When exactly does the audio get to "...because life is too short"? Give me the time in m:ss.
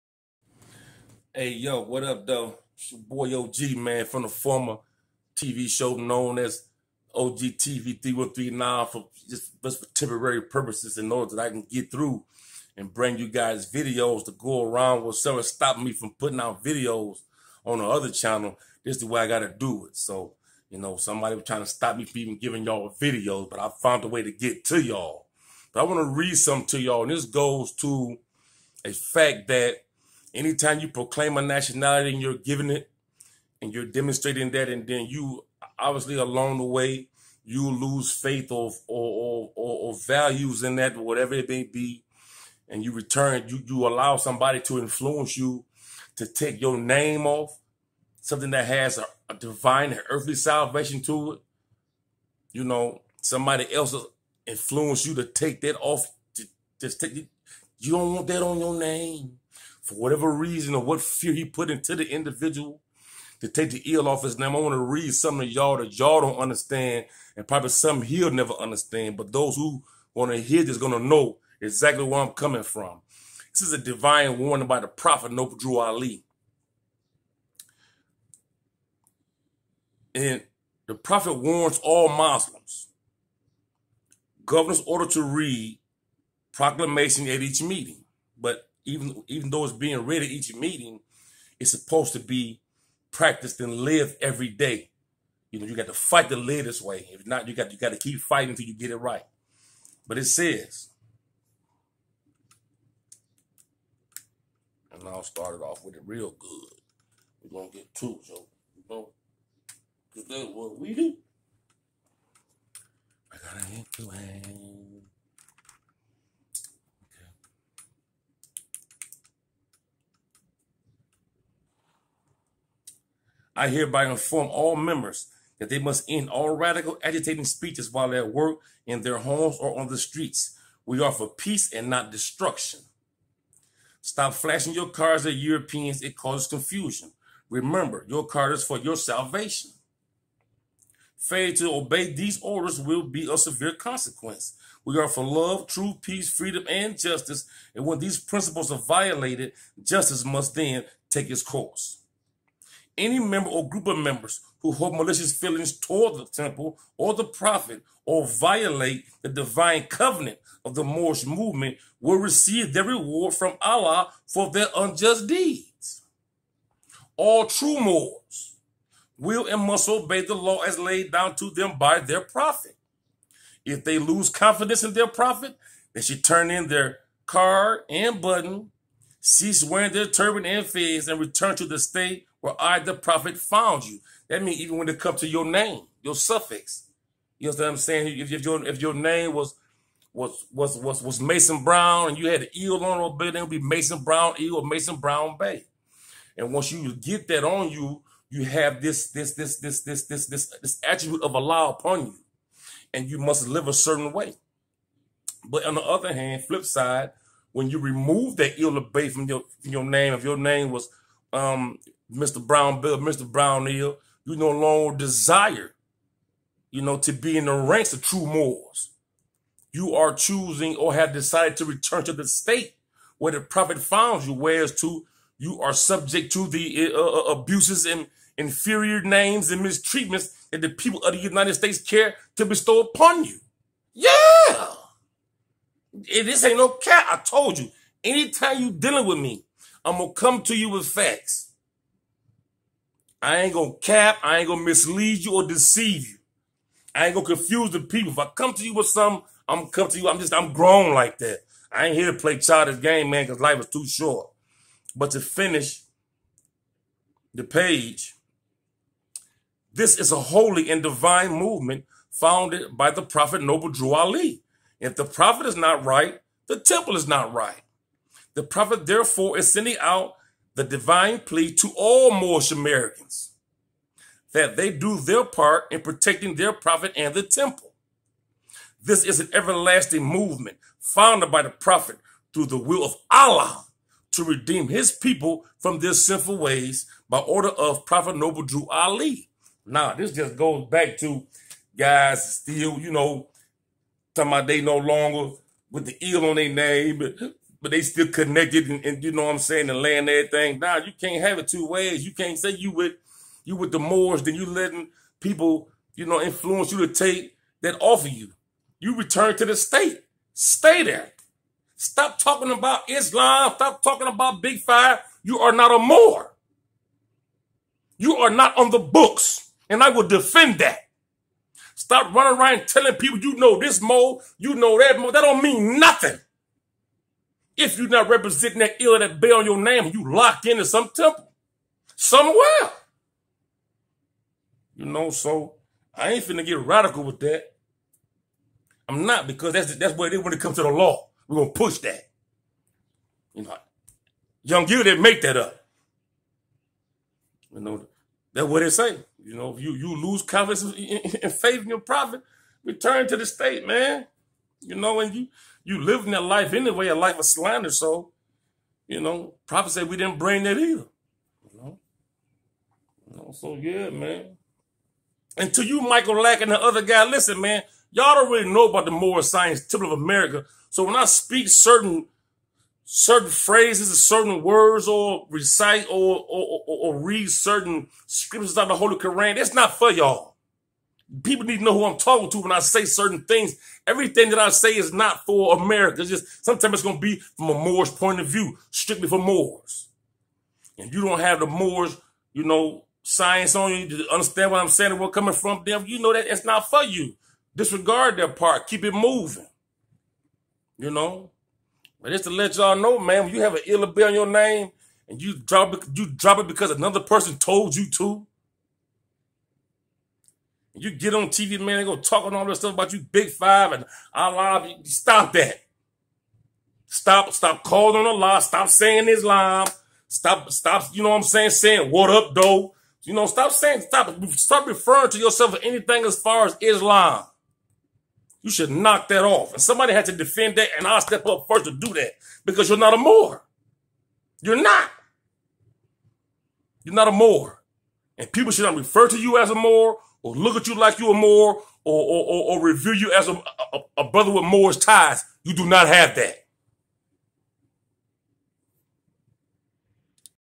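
4:13.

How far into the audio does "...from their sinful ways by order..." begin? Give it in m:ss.
4:45.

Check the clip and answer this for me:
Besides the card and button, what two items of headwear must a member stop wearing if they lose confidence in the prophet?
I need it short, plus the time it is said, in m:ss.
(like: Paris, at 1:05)
Turban and fez, at 3:00.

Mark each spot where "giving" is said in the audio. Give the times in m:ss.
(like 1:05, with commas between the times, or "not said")
0:22, 0:32.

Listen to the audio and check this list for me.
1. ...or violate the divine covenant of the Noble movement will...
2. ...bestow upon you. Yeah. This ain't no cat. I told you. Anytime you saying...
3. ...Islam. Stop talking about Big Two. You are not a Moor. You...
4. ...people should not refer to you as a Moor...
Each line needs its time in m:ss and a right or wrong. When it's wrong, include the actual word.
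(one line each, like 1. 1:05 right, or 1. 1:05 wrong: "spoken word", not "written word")
1. 2:38 wrong: "Moorish", not "Noble"
2. 3:52 wrong: "dealing", not "saying"
3. 5:12 wrong: "Five", not "Two"
4. 7:18 right.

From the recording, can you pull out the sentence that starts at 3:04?
That means even when it comes to your name, your suffix.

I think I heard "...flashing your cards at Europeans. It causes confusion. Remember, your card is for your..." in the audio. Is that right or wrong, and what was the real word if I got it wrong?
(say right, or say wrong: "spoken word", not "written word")
right.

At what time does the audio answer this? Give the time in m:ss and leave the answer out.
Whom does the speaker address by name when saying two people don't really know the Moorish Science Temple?
6:05.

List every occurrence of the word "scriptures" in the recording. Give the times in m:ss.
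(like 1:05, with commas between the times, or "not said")
6:18.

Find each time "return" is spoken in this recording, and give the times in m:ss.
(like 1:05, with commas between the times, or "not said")
0:42, 3:01, 3:41, 5:08, 5:52.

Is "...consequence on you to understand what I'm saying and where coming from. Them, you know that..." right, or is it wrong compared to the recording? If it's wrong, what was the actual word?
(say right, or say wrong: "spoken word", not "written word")
wrong: "science", not "consequence".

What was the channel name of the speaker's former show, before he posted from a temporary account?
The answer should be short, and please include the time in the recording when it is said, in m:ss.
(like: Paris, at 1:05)
OG TV 3139, at 0:07.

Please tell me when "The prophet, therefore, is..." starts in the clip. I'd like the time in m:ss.
4:28.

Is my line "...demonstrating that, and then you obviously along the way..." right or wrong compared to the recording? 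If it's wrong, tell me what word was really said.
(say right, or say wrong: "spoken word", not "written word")
right.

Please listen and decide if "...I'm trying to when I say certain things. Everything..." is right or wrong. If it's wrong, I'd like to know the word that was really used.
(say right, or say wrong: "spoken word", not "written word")
wrong: "talking", not "trying".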